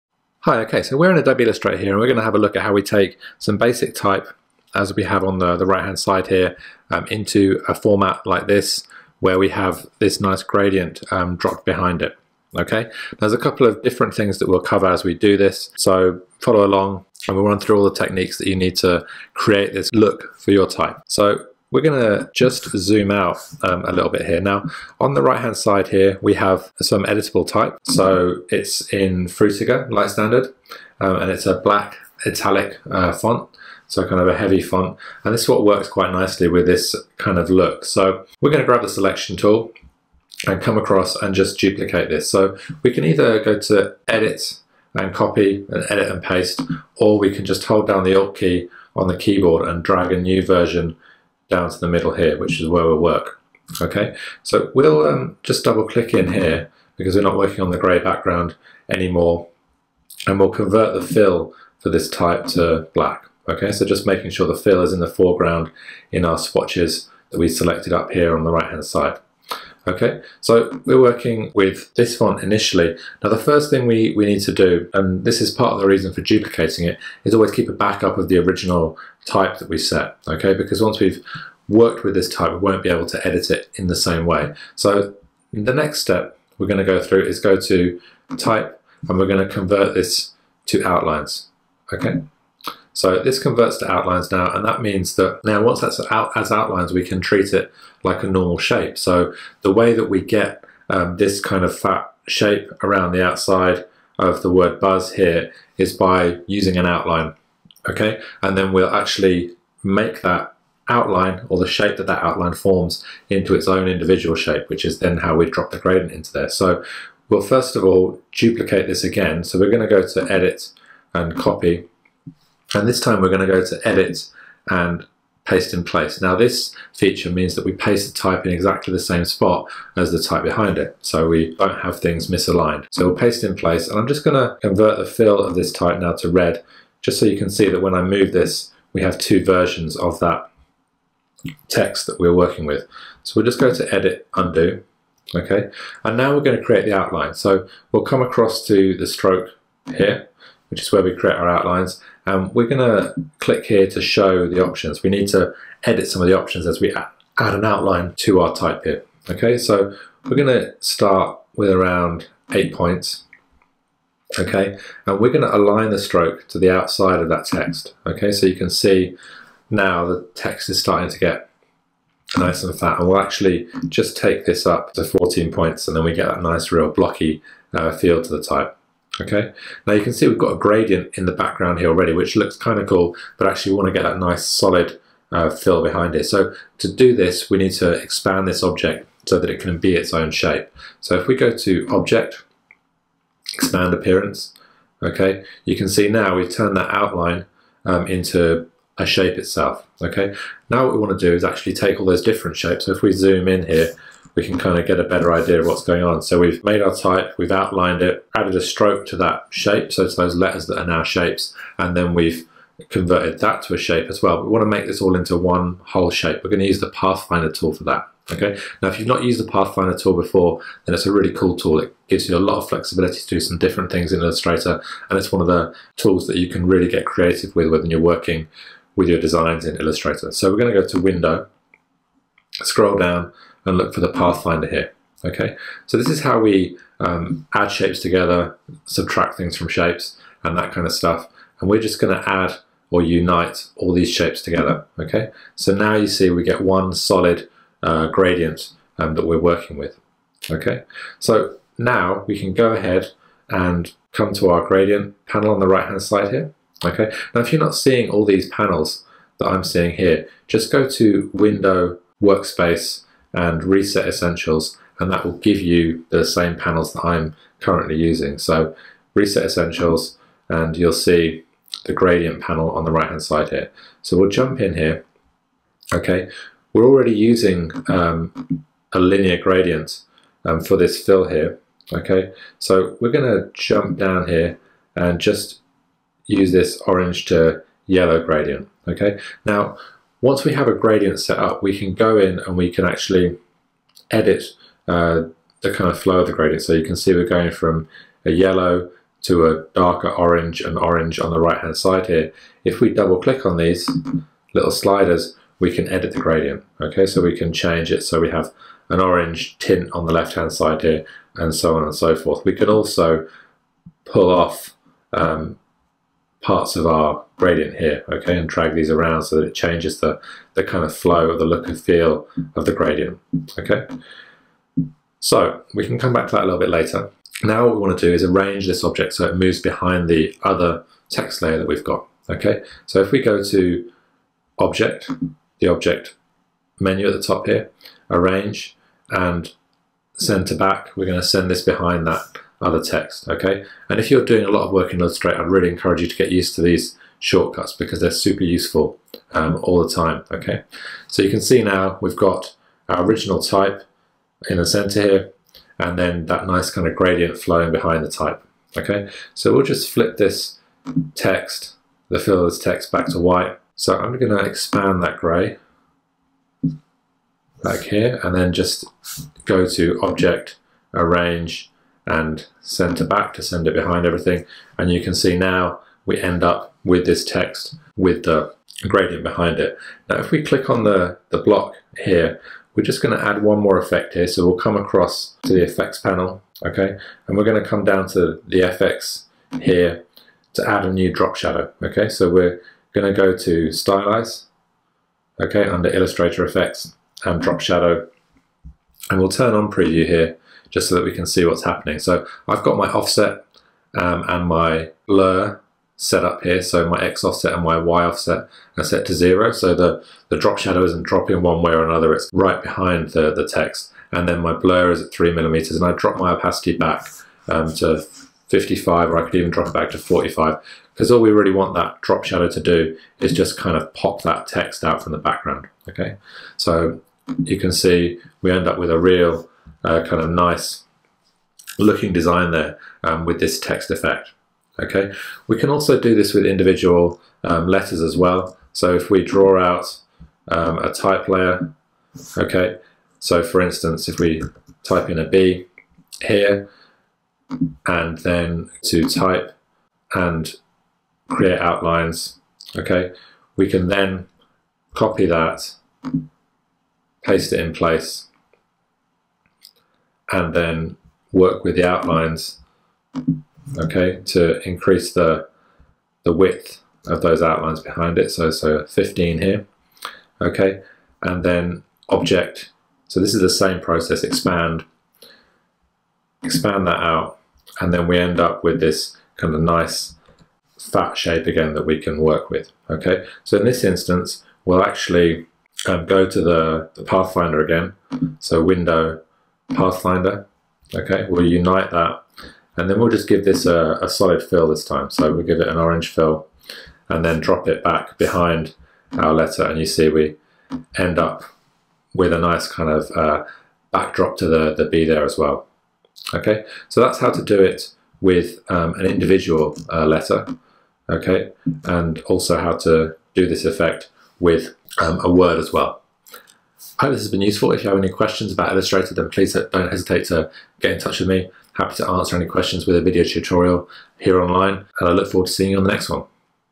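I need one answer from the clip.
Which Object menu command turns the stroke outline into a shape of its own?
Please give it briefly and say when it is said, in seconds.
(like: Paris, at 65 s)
Expand Appearance, at 193 s.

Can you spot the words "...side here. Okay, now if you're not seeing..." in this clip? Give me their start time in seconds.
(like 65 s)
256 s.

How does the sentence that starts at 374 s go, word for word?
And you can see now we end up with this text with the gradient behind it.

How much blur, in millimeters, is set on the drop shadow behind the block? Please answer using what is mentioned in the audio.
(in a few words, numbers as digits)
3 millimeters.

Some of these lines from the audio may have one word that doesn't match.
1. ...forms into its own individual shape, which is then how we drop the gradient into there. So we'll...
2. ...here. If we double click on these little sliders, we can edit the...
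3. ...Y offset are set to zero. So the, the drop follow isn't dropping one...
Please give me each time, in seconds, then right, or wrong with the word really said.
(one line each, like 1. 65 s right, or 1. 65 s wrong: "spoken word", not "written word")
1. 112 s right
2. 302 s right
3. 407 s wrong: "shadow", not "follow".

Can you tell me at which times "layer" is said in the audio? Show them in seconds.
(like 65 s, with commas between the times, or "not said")
331 s, 441 s.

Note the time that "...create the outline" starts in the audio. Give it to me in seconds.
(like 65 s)
146 s.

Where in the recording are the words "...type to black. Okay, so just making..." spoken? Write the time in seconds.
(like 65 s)
62 s.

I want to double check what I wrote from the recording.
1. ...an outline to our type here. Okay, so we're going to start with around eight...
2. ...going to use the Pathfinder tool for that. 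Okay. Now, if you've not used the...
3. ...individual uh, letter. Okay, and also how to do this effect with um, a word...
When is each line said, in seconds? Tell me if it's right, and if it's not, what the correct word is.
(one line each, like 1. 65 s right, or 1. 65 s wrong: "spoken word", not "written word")
1. 157 s right
2. 216 s right
3. 509 s right.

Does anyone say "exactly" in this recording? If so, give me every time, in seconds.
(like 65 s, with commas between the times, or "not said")
128 s.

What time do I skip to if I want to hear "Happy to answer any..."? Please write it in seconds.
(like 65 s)
521 s.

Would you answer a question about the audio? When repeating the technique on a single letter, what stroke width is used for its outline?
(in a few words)
15.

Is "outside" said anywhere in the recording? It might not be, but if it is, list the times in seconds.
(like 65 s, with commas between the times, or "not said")
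103 s, 166 s.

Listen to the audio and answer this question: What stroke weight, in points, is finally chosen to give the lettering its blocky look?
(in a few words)
14 points.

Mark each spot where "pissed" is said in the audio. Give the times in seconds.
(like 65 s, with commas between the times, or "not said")
not said.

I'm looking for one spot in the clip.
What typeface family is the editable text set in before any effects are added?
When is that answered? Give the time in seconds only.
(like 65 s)
29 s.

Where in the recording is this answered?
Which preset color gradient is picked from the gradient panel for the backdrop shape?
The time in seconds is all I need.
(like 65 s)
286 s.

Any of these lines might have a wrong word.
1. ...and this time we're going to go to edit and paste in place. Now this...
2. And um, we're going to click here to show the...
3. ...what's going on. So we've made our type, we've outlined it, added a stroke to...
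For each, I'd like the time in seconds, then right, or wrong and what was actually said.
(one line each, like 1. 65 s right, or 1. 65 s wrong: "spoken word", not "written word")
1. 122 s right
2. 152 s right
3. 205 s right.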